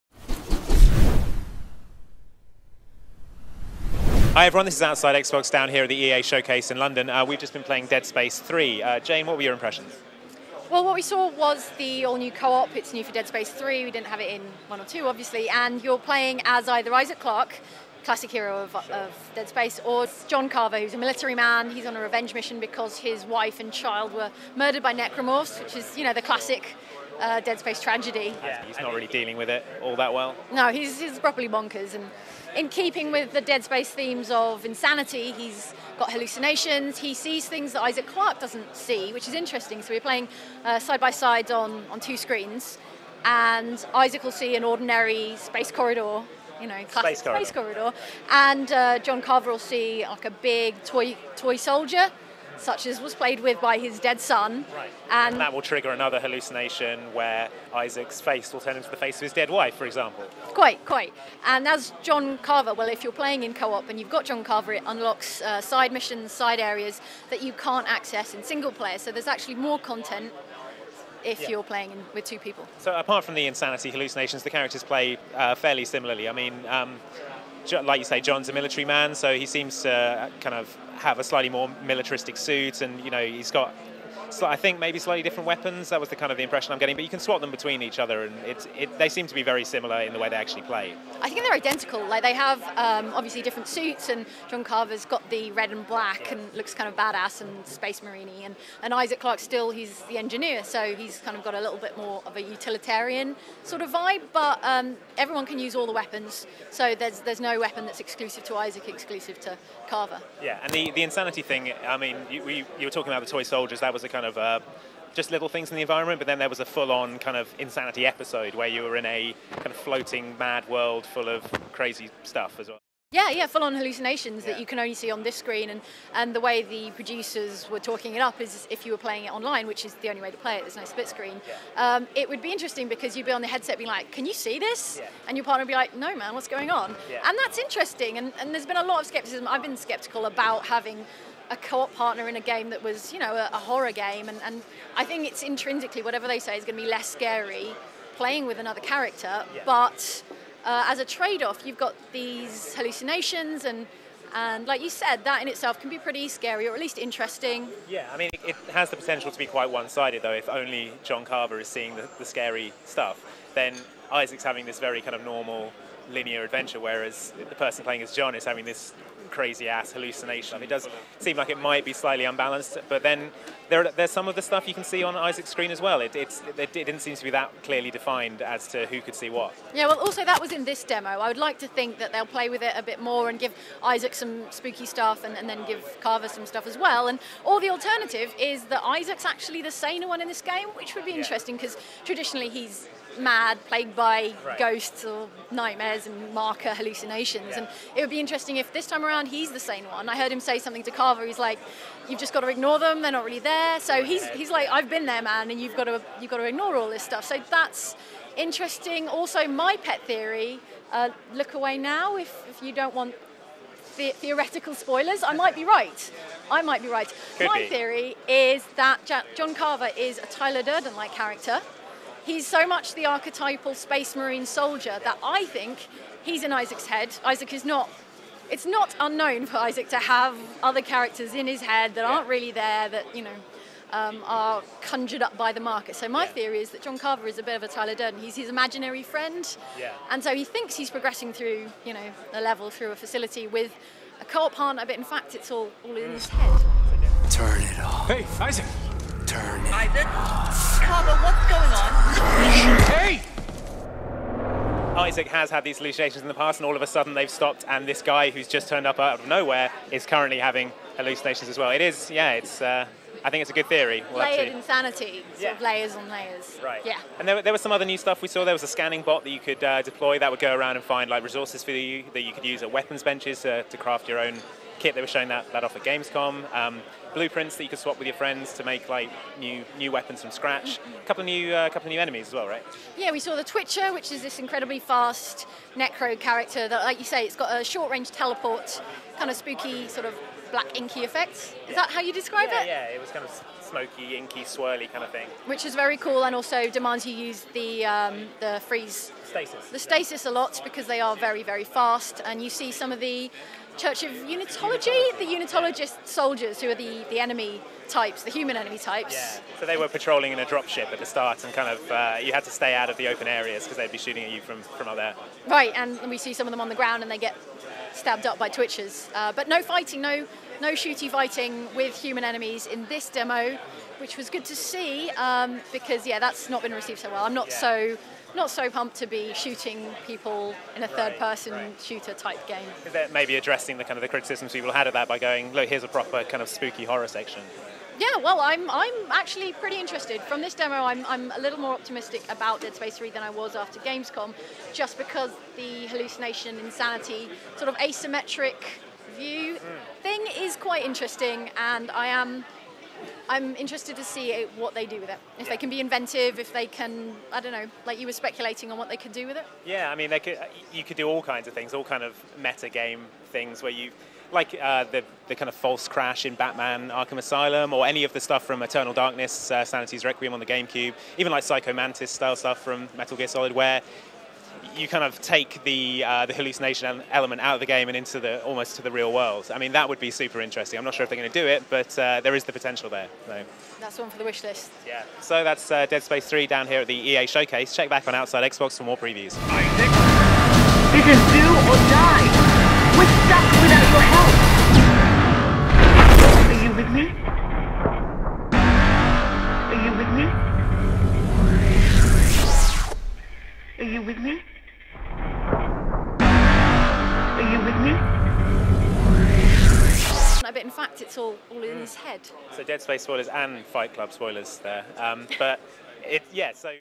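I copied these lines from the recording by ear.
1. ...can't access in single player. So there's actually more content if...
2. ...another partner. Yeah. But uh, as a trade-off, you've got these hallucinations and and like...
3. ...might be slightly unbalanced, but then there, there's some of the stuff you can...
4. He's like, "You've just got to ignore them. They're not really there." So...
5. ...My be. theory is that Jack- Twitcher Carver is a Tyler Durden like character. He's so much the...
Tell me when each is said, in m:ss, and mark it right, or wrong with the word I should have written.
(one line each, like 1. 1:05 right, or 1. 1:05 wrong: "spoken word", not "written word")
1. 1:07 right
2. 2:28 wrong: "character", not "partner"
3. 2:51 right
4. 3:21 right
5. 3:37 wrong: "John", not "Twitcher".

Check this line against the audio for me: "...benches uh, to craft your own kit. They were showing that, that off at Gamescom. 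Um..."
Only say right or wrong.
right.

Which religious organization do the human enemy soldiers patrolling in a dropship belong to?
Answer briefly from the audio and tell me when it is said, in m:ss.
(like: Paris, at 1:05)
Church of Unitology, at 5:03.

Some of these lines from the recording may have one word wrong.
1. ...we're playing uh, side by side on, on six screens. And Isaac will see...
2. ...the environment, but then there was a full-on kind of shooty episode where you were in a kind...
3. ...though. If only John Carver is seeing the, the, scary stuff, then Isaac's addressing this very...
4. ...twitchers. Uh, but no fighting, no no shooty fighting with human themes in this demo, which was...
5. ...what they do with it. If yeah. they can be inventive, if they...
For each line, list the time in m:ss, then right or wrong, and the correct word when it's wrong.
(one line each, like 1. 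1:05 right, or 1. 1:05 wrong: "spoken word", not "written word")
1. 0:39 wrong: "two", not "six"
2. 1:55 wrong: "insanity", not "shooty"
3. 2:40 wrong: "having", not "addressing"
4. 5:18 wrong: "enemies", not "themes"
5. 5:54 right.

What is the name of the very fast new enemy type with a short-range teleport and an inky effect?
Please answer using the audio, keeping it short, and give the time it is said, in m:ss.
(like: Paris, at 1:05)
Twitcher, at 4:43.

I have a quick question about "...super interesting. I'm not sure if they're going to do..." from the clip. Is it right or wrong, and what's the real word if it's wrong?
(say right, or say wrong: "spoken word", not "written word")
right.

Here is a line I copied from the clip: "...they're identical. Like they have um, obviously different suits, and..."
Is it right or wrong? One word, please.
right.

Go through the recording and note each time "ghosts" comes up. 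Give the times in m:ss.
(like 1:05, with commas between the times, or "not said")
3:14.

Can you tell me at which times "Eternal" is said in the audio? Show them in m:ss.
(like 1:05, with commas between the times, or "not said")
6:08.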